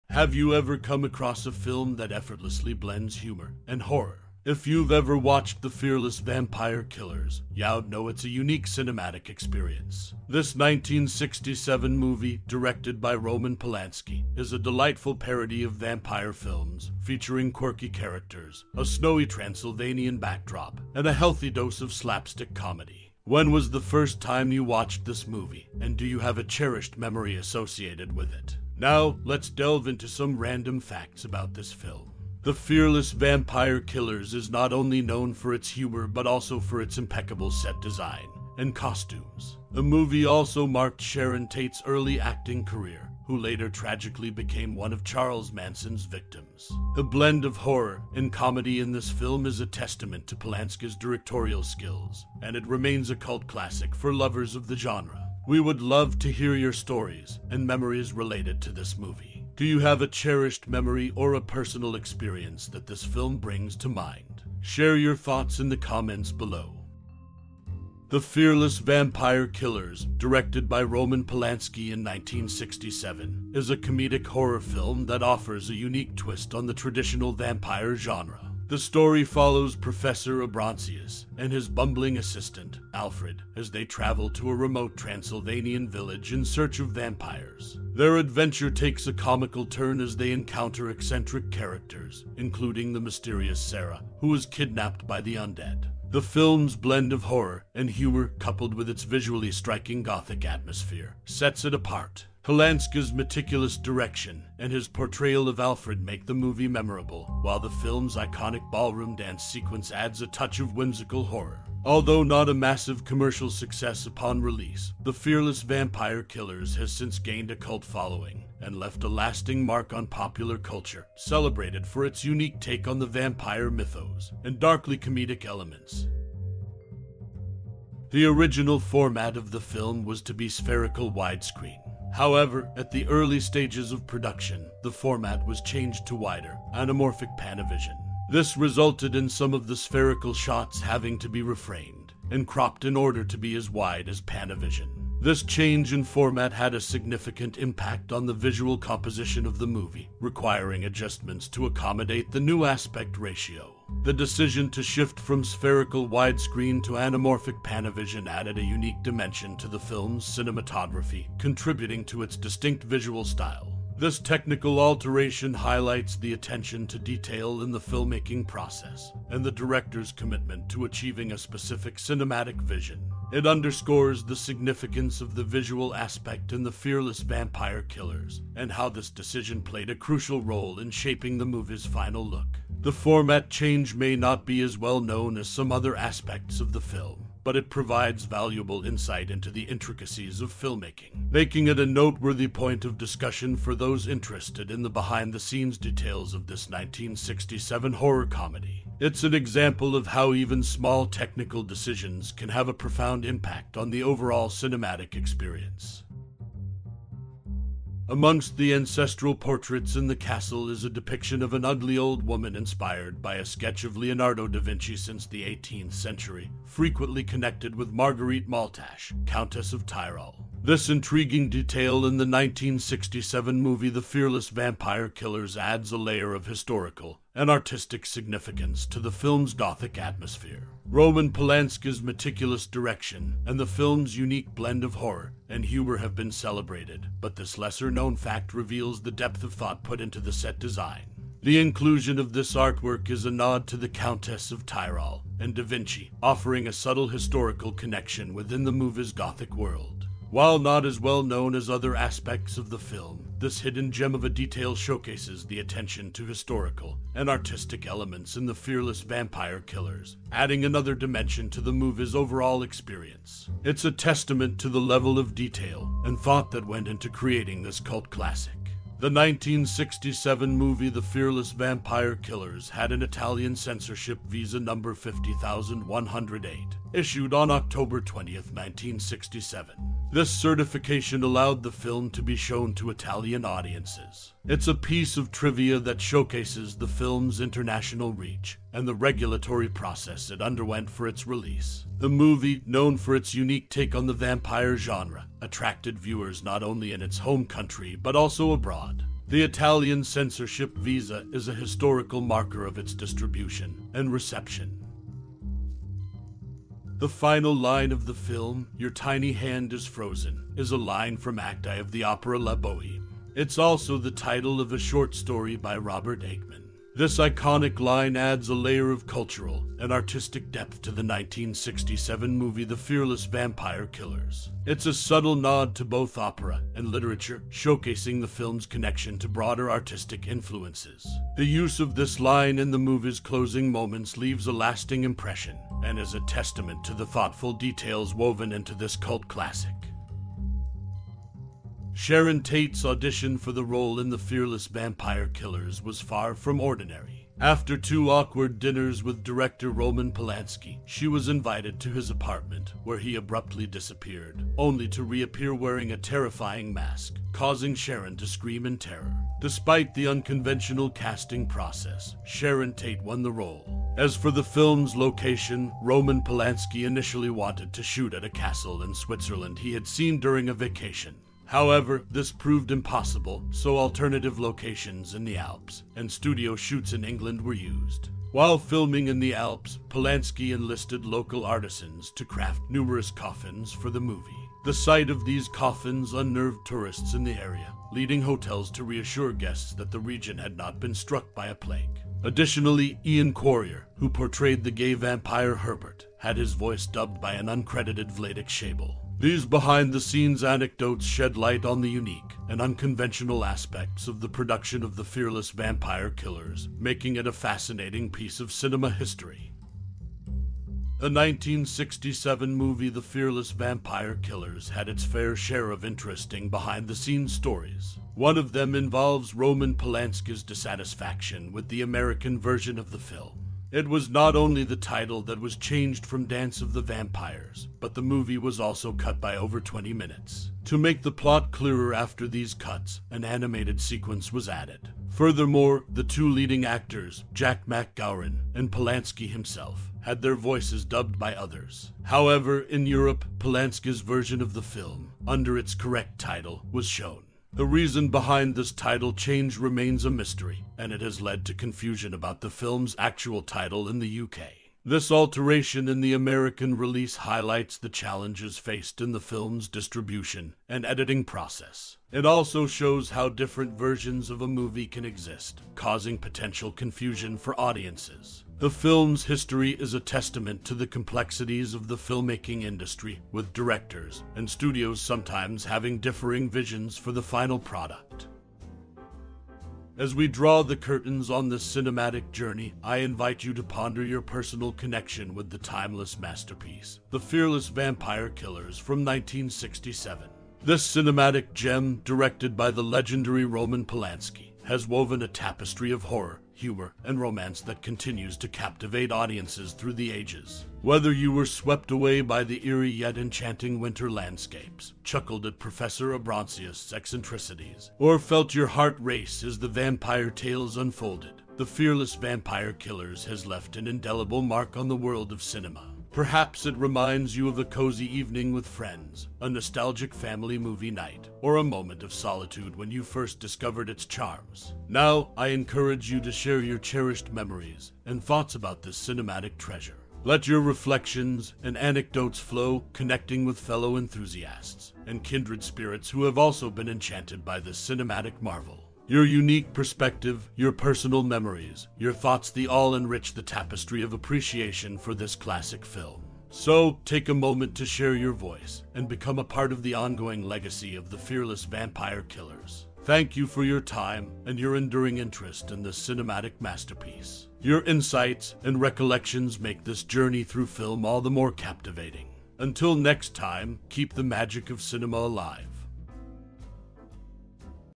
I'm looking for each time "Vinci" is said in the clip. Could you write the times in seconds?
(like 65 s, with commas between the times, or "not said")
214 s, 245 s.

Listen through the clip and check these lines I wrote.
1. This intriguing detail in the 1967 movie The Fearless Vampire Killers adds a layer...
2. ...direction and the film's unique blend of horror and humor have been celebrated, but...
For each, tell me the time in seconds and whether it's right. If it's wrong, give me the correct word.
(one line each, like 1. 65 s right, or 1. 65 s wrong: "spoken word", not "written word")
1. 220 s right
2. 232 s right.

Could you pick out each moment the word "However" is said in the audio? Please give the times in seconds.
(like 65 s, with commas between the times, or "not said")
132 s, 371 s, 442 s.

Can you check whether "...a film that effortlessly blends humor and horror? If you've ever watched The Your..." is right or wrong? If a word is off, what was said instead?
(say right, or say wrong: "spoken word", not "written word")
wrong: "Fearless", not "Your".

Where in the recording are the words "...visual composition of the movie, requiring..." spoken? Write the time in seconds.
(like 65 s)
148 s.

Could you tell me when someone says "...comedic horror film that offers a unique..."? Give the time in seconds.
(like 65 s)
73 s.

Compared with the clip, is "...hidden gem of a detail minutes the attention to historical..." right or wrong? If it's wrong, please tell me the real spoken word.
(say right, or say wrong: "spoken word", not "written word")
wrong: "showcases", not "minutes".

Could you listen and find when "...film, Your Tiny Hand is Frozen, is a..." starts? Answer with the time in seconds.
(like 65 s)
308 s.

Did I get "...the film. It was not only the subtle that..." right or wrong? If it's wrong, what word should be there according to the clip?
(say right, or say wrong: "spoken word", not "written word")
wrong: "title", not "subtle".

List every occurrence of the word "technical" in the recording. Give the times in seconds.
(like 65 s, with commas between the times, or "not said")
164 s, 201 s.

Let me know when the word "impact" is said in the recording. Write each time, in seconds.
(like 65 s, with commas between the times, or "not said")
147 s, 203 s.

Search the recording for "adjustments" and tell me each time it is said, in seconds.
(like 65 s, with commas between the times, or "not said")
150 s.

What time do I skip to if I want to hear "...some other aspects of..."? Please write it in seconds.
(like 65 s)
185 s.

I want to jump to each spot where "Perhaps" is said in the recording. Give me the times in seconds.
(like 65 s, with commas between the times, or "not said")
516 s.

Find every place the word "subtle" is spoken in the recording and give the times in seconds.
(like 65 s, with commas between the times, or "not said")
246 s, 324 s.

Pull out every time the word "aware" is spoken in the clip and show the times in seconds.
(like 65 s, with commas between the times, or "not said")
not said.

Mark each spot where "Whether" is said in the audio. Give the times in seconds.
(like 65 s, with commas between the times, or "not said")
500 s.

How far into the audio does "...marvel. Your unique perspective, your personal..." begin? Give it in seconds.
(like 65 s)
538 s.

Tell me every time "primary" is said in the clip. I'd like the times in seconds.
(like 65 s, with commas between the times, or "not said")
not said.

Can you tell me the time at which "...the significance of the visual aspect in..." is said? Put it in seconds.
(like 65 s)
174 s.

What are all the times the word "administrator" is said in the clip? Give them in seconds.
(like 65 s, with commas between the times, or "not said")
not said.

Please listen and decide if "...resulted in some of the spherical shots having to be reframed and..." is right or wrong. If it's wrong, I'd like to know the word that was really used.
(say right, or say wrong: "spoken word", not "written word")
right.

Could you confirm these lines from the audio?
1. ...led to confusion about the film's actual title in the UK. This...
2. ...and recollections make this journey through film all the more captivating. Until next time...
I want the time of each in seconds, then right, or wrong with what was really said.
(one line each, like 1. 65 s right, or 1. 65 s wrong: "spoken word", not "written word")
1. 451 s right
2. 558 s right.